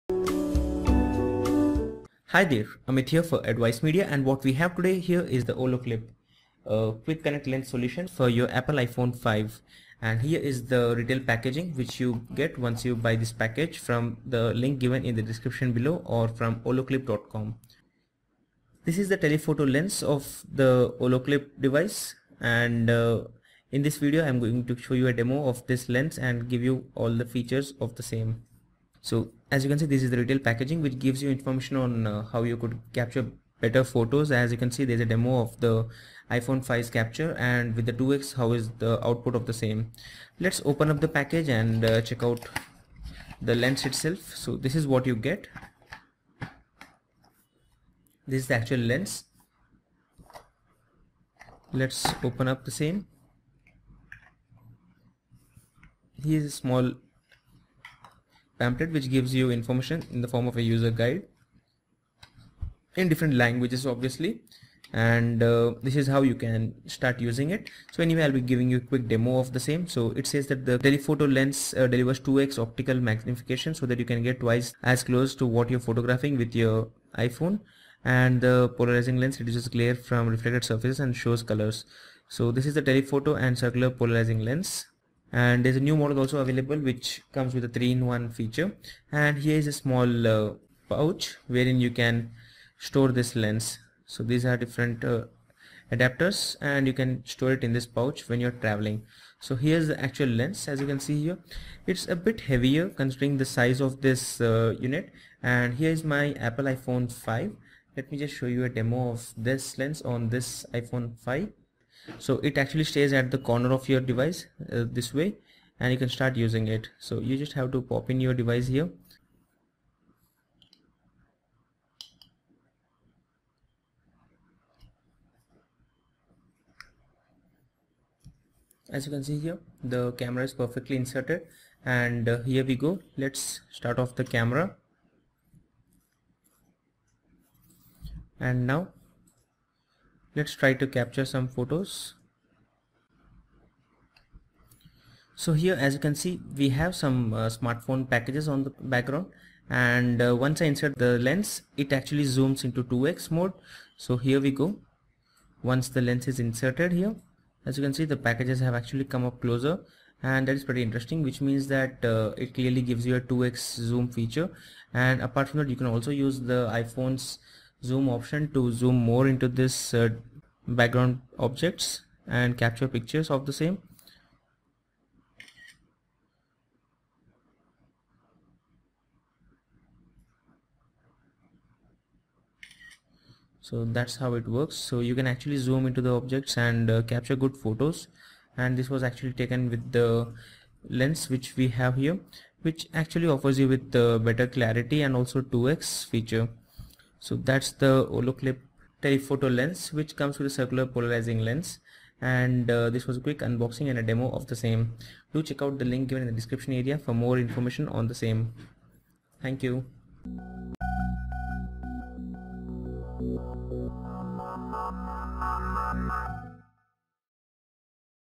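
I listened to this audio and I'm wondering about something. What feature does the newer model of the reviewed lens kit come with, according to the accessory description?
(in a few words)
3-in-1.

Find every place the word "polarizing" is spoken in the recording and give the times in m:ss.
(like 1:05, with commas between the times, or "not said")
1:18, 1:24, 3:20.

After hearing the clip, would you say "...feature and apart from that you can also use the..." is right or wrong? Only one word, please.
right.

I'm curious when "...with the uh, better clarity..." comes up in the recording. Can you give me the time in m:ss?
3:13.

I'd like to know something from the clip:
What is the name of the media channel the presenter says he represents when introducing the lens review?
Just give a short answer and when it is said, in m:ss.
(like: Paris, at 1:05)
Advice Media, at 0:03.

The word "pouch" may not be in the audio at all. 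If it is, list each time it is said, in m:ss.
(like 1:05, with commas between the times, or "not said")
1:30, 1:37.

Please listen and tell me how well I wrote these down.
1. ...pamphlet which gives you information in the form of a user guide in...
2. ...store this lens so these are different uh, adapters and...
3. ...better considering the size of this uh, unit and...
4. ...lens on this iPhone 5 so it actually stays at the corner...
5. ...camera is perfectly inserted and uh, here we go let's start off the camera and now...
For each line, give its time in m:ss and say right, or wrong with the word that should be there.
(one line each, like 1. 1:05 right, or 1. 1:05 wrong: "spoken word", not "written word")
1. 0:58 right
2. 1:32 right
3. 1:42 wrong: "heavier", not "better"
4. 1:49 right
5. 2:10 right.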